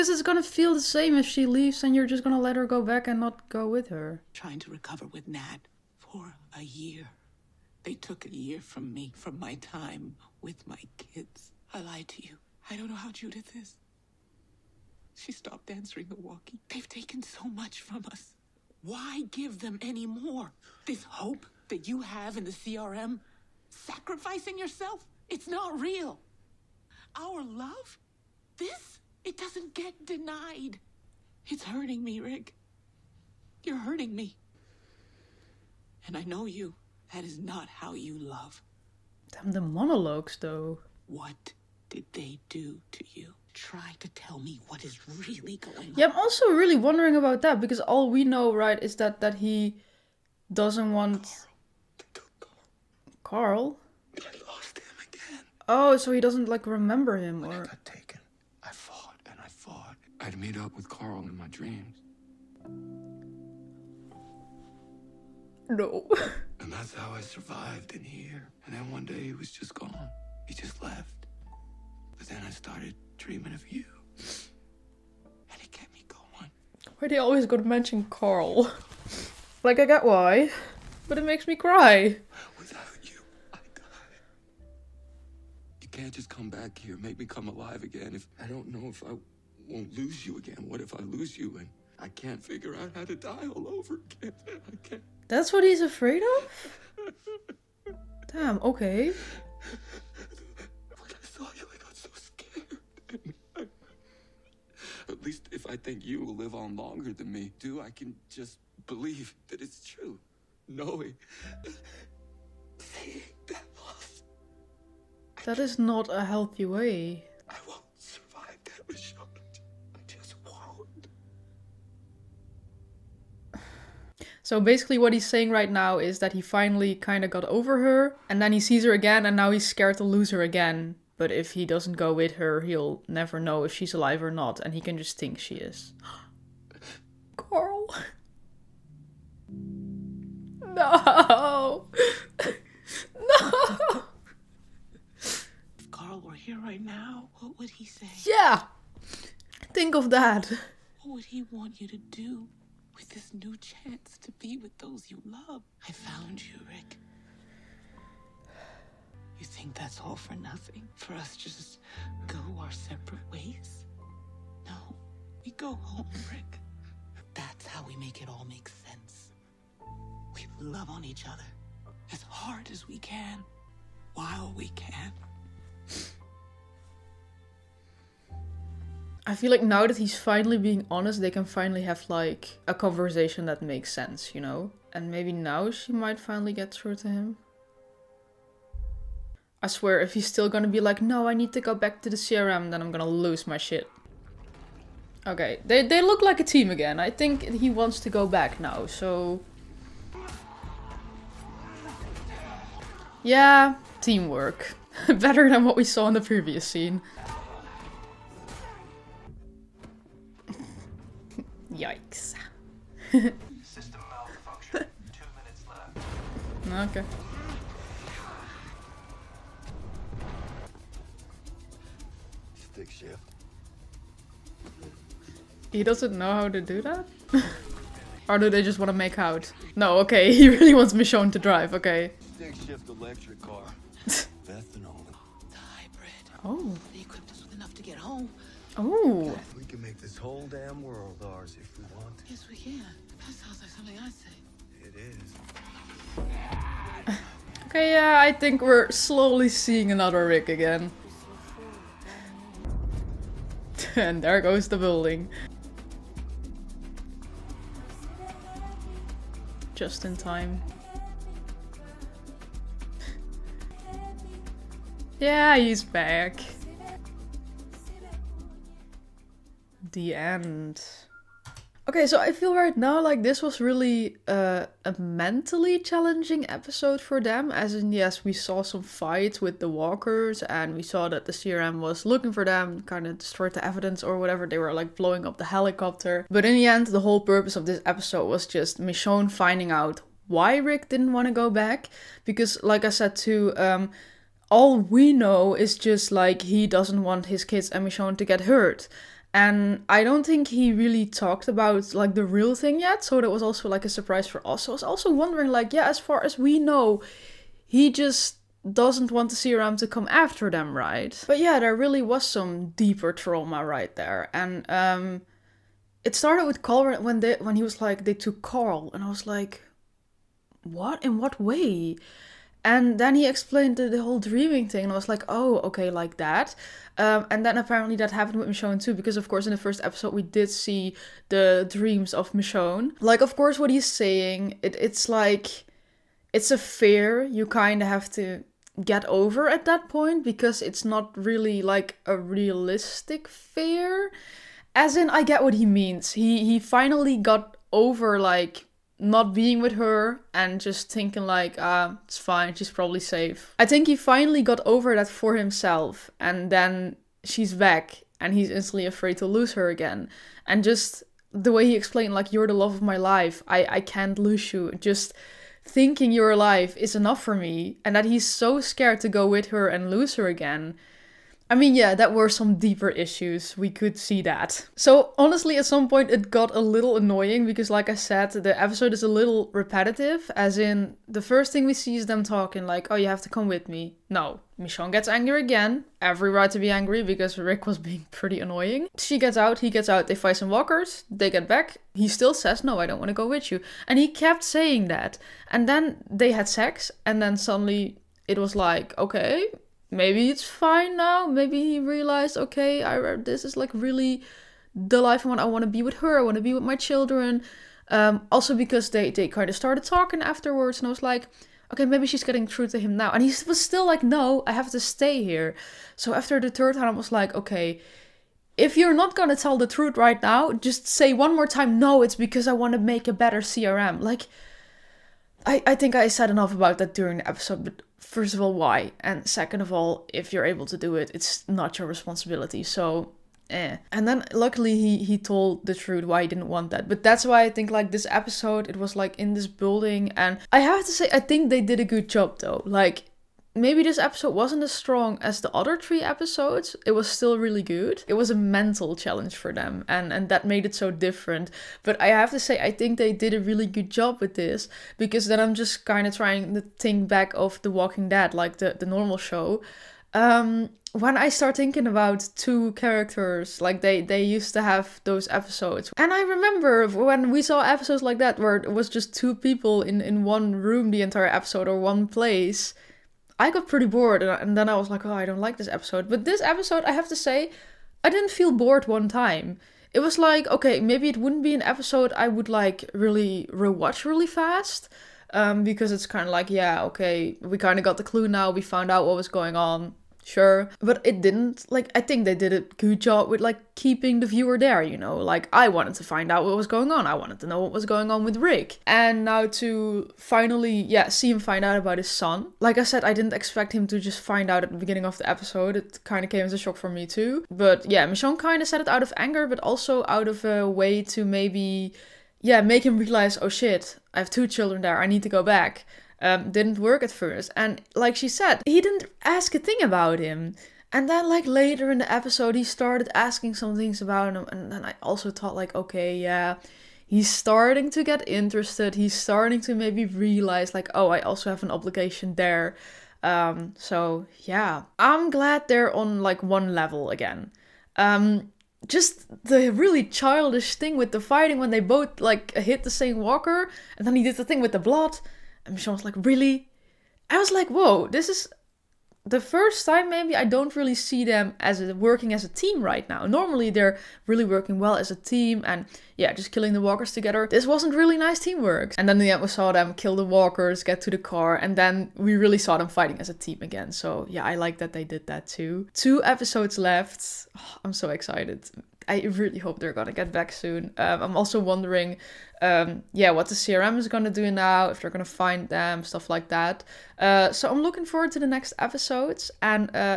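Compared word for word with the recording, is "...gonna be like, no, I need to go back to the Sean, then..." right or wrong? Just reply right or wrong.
wrong.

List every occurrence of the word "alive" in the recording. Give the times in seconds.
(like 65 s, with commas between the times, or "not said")
87 s, 133 s, 366 s.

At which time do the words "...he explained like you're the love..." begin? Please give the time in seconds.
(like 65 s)
361 s.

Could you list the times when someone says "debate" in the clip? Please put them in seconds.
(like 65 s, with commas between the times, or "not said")
not said.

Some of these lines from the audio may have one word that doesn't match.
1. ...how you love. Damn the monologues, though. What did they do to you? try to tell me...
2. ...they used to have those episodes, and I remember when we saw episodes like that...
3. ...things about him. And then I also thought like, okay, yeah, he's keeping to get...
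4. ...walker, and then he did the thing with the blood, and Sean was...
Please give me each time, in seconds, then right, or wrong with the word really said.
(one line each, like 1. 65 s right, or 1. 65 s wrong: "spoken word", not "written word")
1. 37 s right
2. 464 s right
3. 523 s wrong: "starting", not "keeping"
4. 543 s right.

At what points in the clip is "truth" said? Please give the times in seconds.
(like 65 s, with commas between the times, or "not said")
419 s, 435 s.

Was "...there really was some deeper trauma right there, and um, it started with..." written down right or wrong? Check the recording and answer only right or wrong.
right.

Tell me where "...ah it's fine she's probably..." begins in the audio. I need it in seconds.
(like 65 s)
351 s.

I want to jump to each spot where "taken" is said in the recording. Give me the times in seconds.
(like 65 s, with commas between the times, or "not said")
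16 s, 57 s.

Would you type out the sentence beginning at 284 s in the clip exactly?
They were like blowing up the helicopter.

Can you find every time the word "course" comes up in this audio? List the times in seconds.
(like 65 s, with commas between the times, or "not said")
329 s, 333 s.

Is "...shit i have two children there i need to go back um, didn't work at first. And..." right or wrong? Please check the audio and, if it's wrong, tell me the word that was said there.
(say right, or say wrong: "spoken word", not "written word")
right.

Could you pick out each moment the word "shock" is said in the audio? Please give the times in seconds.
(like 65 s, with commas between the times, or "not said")
506 s.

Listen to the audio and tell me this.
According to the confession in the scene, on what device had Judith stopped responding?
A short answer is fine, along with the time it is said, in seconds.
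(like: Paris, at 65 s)
Walkie, at 16 s.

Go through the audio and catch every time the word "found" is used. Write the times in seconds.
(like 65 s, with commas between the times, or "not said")
155 s, 488 s.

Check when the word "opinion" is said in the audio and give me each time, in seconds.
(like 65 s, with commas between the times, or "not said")
not said.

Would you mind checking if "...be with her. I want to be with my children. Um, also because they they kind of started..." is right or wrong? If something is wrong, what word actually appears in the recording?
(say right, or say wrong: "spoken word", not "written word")
right.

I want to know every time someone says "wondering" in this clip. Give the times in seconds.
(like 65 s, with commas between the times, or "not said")
46 s, 305 s, 571 s.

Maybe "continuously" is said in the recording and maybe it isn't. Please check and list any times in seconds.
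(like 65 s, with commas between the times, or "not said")
not said.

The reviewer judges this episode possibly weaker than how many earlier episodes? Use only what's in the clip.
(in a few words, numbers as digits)
3.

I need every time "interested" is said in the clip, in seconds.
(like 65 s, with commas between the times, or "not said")
528 s.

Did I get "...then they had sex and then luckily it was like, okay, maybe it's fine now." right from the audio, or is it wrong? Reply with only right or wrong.
wrong.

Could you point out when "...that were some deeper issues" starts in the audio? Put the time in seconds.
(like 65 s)
371 s.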